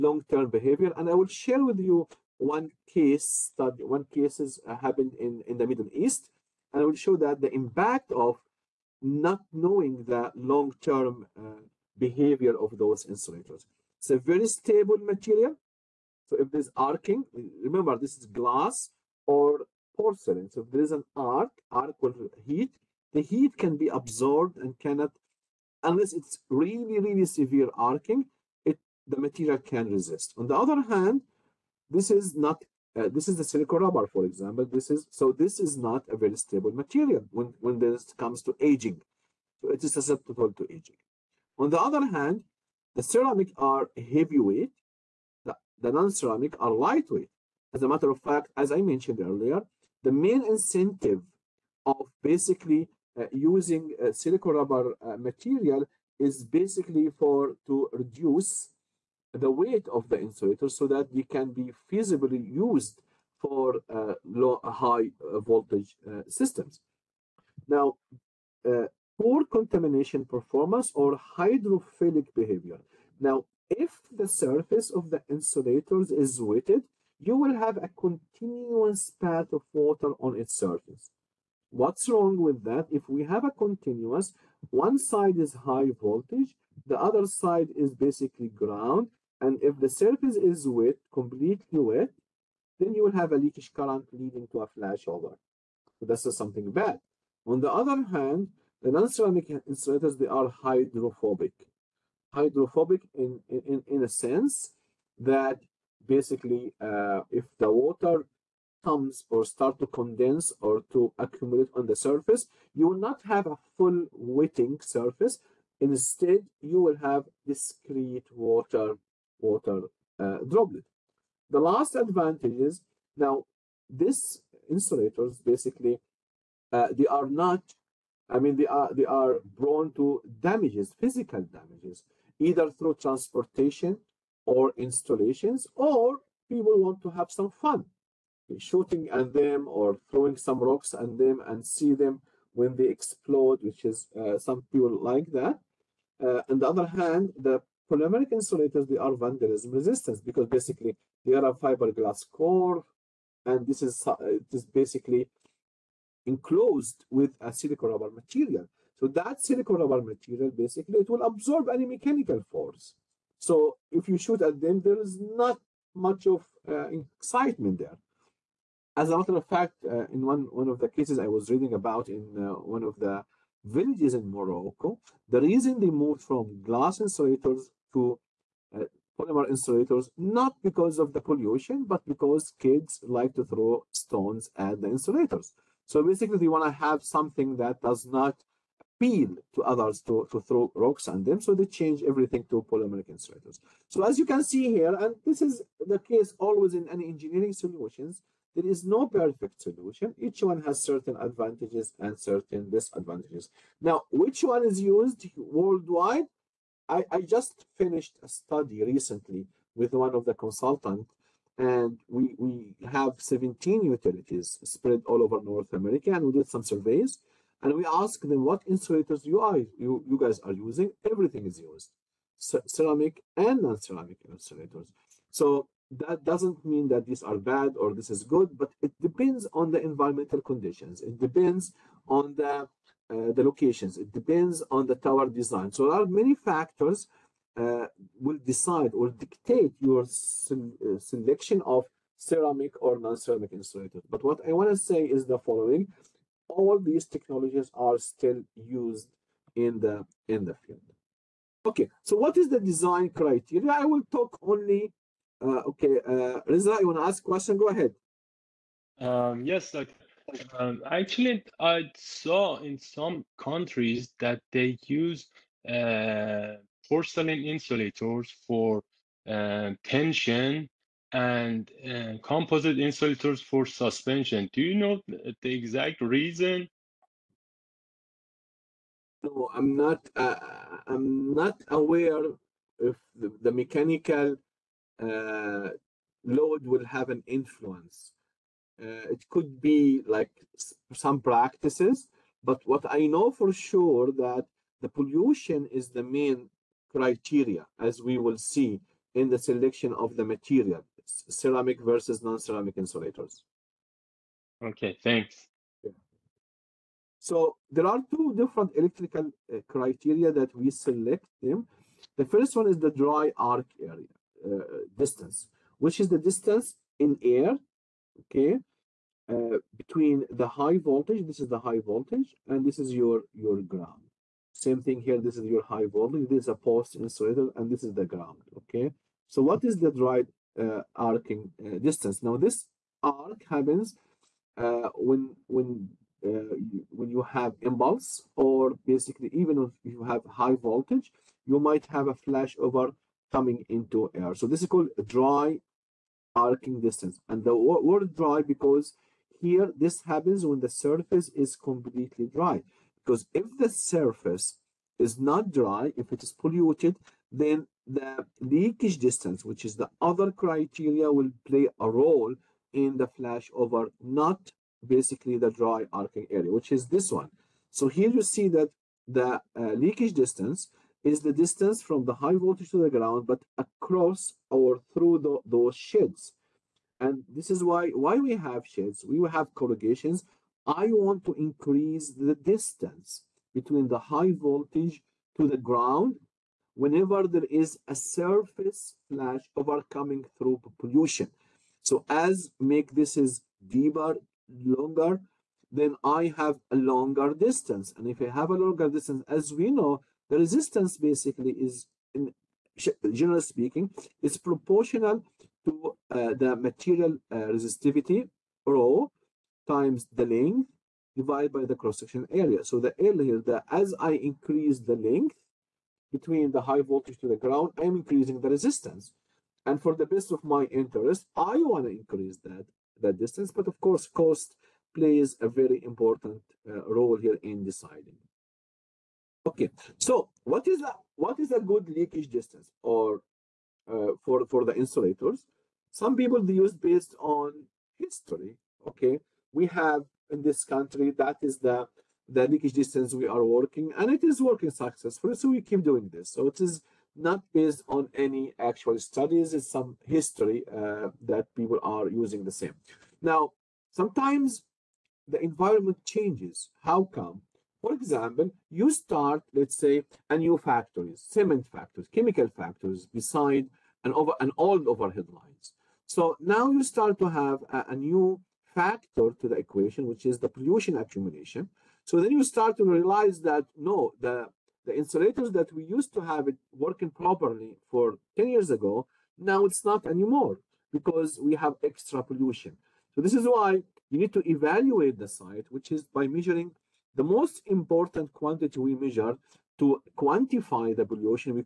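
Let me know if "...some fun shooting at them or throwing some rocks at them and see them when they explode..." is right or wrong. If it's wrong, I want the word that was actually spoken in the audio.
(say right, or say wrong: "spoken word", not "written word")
right.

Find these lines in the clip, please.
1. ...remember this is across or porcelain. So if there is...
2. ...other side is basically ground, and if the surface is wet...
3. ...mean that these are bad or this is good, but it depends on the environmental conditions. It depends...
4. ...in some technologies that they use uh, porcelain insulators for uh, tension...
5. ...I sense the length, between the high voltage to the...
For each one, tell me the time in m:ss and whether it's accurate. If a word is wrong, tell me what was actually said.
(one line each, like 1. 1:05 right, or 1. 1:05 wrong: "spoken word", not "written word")
1. 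0:17 wrong: "glass", not "across"
2. 1:26 right
3. 3:46 right
4. 4:22 wrong: "countries", not "technologies"
5. 6:53 wrong: "increase", not "sense".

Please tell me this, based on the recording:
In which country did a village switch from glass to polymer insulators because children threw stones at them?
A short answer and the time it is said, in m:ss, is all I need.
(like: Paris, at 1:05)
Morocco, at 2:54.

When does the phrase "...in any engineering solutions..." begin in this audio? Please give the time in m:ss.
3:16.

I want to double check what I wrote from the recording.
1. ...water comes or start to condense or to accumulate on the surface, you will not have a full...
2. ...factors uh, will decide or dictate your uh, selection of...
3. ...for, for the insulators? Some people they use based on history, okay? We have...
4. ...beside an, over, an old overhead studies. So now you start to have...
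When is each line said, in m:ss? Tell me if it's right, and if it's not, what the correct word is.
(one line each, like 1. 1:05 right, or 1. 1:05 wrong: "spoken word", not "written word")
1. 1:47 right
2. 3:56 right
3. 7:14 right
4. 7:43 wrong: "lines", not "studies".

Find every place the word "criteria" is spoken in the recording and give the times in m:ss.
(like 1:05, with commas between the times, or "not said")
4:13, 4:56, 5:09, 6:00.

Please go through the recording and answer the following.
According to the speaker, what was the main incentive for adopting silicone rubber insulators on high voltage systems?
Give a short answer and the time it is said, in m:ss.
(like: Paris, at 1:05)
Reduce the weight, at 0:57.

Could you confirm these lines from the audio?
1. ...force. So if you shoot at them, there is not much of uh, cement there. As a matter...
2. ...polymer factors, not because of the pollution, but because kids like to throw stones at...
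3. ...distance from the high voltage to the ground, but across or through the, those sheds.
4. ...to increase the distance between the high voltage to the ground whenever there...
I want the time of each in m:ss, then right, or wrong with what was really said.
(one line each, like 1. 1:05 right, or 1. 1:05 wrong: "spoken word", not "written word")
1. 2:42 wrong: "excitement", not "cement"
2. 2:59 wrong: "insulators", not "factors"
3. 6:11 right
4. 6:21 right.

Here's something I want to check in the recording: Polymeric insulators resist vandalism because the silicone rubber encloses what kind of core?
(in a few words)
Fiberglass core.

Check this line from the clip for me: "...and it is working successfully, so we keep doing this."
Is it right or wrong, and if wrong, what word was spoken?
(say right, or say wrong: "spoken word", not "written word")
right.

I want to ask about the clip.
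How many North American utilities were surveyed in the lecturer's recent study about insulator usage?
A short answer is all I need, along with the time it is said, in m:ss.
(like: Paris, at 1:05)
17, at 3:33.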